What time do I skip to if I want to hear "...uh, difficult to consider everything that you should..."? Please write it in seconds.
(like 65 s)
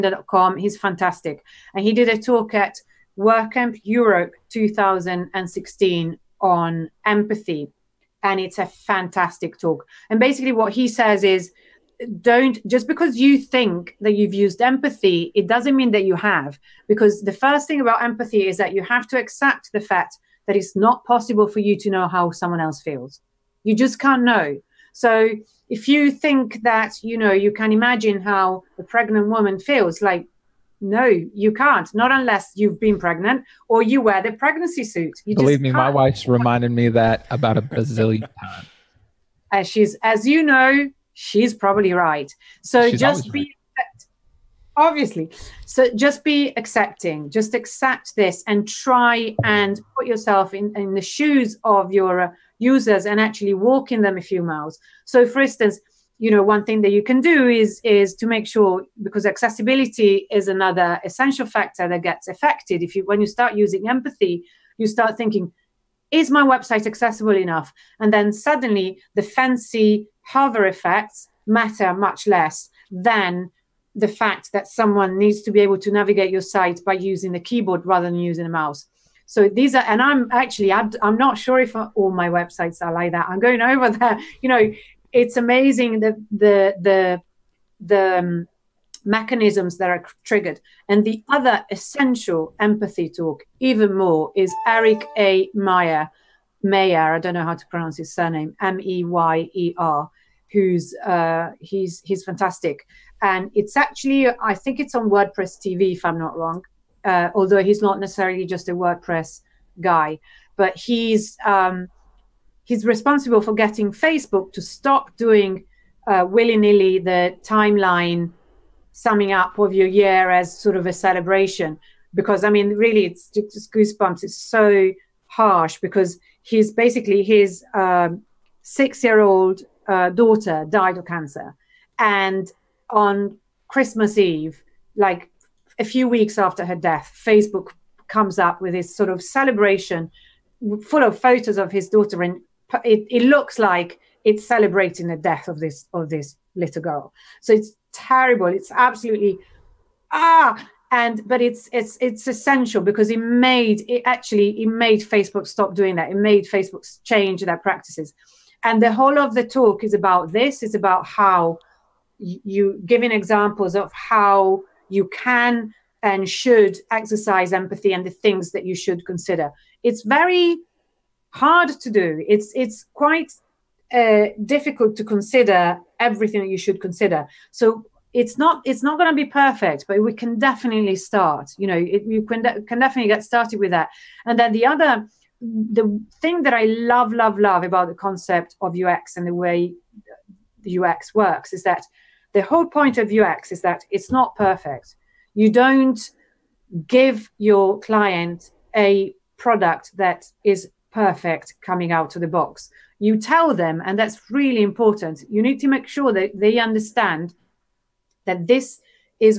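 173 s.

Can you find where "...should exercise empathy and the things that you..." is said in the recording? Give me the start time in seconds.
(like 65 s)
166 s.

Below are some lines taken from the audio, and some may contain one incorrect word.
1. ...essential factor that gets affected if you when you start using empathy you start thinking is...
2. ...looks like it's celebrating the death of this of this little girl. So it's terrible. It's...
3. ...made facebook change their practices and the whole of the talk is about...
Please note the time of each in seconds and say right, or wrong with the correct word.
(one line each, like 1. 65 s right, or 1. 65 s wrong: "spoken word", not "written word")
1. 61 s right
2. 143 s right
3. 156 s right.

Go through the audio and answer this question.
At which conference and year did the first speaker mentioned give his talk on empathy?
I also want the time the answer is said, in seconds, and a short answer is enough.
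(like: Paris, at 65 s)
WordCamp Europe 2016, at 3 s.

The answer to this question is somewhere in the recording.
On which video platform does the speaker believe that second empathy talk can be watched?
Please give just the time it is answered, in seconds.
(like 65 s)
105 s.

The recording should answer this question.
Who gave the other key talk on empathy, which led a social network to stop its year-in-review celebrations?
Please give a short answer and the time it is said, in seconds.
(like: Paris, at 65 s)
Eric A. Meyer, at 94 s.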